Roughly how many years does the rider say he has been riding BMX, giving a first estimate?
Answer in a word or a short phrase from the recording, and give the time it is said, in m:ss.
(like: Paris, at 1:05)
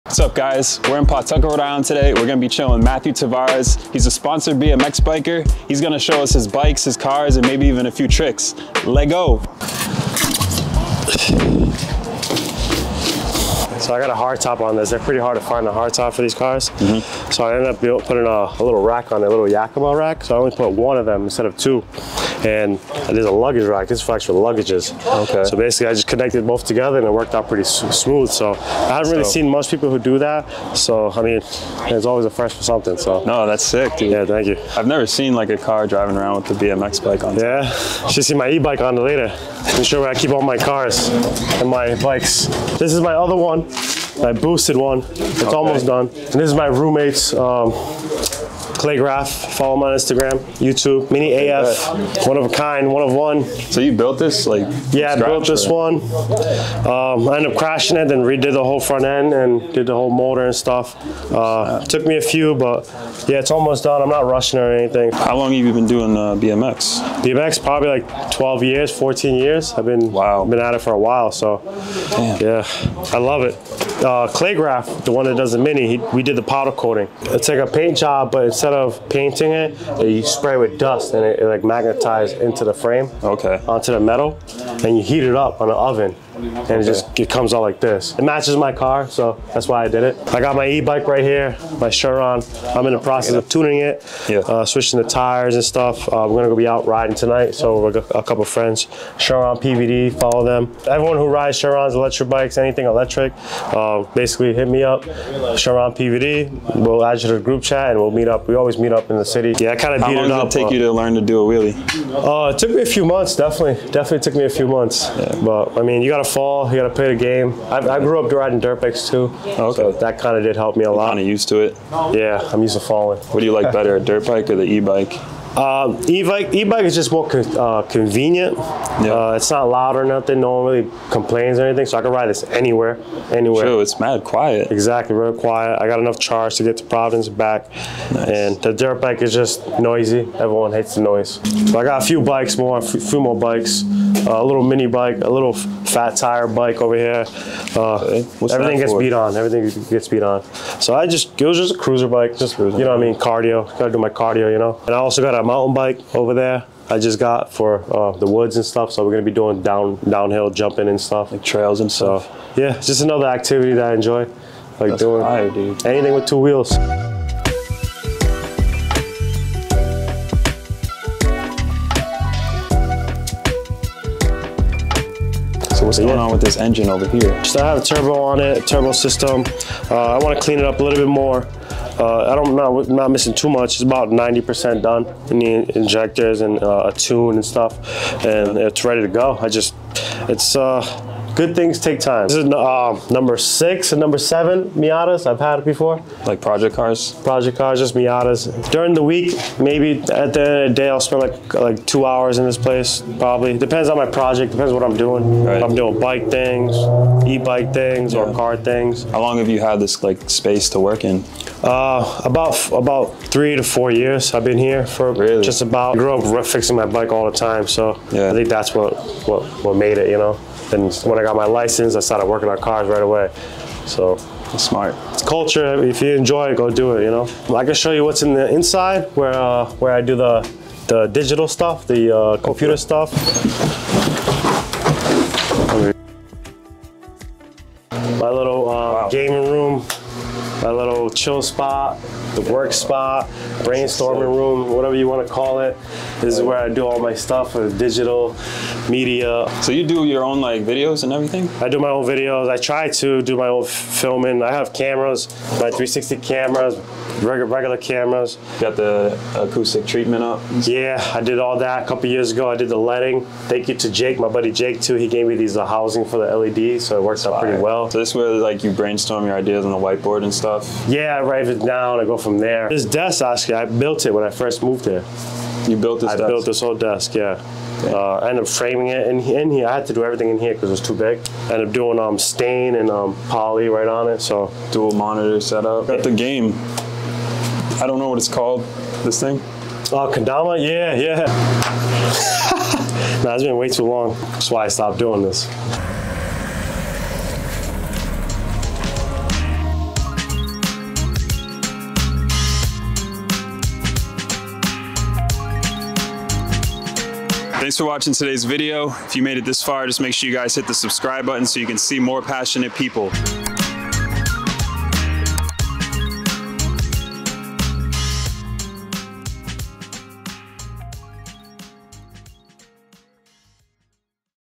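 12 years, at 1:08.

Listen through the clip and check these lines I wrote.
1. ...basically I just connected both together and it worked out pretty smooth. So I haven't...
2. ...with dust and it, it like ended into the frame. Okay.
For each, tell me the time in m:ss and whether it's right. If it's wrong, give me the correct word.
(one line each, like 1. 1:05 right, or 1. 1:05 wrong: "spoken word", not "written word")
1. 0:25 right
2. 1:20 wrong: "magnetized", not "ended".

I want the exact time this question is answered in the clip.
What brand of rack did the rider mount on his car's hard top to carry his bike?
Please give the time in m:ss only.
0:19.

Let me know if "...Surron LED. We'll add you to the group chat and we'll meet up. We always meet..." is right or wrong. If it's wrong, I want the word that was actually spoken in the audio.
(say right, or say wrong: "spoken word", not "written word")
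wrong: "PVD", not "LED".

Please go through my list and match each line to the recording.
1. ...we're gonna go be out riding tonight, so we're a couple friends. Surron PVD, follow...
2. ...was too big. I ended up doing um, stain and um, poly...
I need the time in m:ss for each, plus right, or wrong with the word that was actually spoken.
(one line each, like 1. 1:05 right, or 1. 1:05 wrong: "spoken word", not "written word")
1. 1:36 right
2. 4:40 right.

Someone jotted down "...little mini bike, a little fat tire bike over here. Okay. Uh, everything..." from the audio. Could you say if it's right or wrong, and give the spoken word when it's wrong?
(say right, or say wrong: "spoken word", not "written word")
right.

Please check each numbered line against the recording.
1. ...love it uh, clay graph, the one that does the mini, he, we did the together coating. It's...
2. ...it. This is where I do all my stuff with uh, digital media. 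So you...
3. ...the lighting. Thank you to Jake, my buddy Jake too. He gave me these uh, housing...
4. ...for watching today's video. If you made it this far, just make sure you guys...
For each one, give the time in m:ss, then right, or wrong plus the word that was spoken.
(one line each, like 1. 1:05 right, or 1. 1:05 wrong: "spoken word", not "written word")
1. 1:13 wrong: "powder", not "together"
2. 4:05 right
3. 4:22 right
4. 5:07 right.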